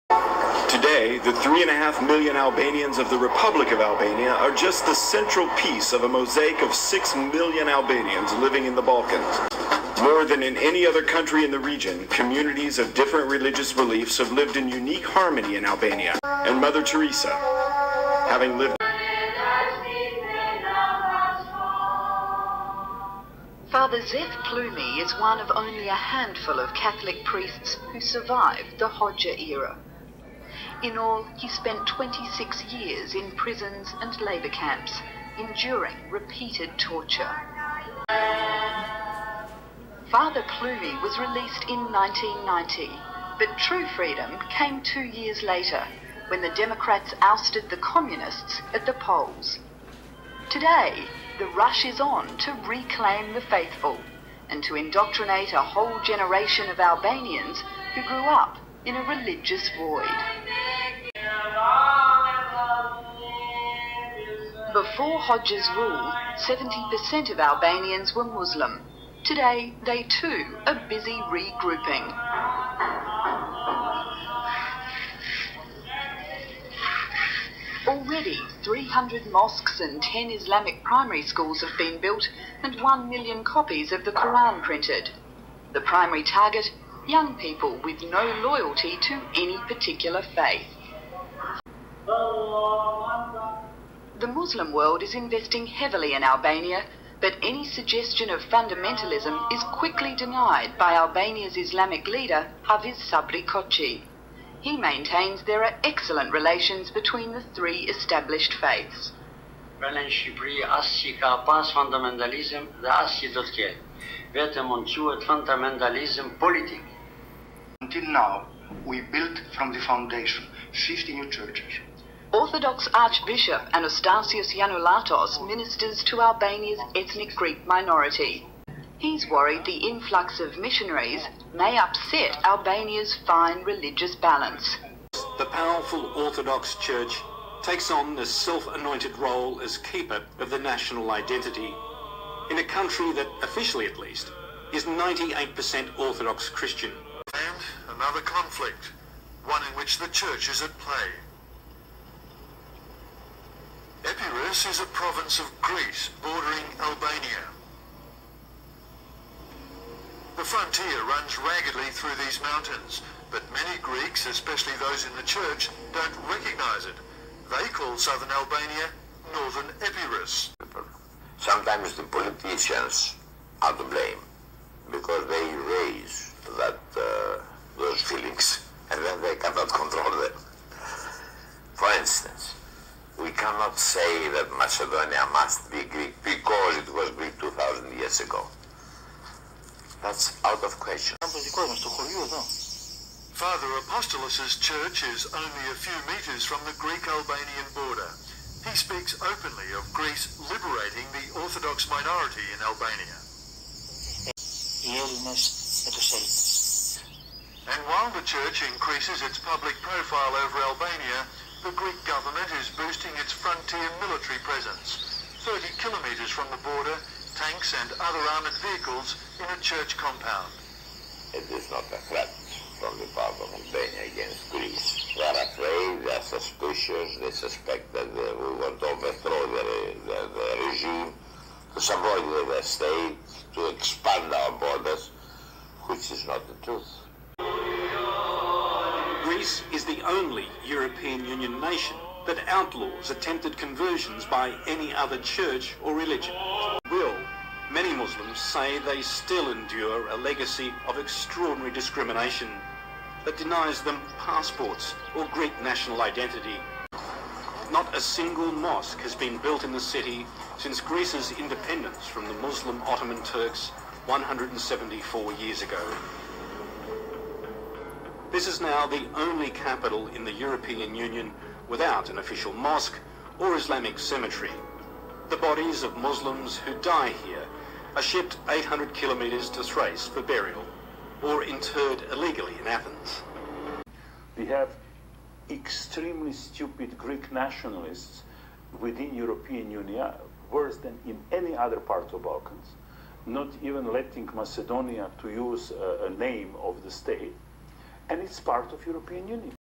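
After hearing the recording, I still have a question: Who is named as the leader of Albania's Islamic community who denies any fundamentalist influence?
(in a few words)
Hafiz Sabri Koci.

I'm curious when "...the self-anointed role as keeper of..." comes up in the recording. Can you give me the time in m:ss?
2:18.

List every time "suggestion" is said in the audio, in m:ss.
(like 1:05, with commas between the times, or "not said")
1:37.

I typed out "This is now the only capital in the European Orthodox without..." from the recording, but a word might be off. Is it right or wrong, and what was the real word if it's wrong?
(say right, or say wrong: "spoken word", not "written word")
wrong: "Union", not "Orthodox".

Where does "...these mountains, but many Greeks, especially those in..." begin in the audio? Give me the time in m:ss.
2:42.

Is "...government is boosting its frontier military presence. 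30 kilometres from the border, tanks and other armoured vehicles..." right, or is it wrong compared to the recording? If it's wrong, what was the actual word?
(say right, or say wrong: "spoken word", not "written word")
right.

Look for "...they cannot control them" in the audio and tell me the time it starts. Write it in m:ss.
2:59.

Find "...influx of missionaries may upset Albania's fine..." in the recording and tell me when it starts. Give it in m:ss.
2:09.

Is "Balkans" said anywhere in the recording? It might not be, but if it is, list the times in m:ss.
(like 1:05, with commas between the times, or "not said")
0:08, 4:52.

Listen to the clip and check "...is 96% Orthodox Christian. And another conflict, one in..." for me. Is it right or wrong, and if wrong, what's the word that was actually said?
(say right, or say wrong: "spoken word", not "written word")
wrong: "98", not "96".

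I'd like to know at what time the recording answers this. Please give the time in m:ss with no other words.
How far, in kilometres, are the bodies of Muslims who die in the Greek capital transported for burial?
4:38.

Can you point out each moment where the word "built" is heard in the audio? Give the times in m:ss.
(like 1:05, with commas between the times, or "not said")
1:21, 1:59, 4:19.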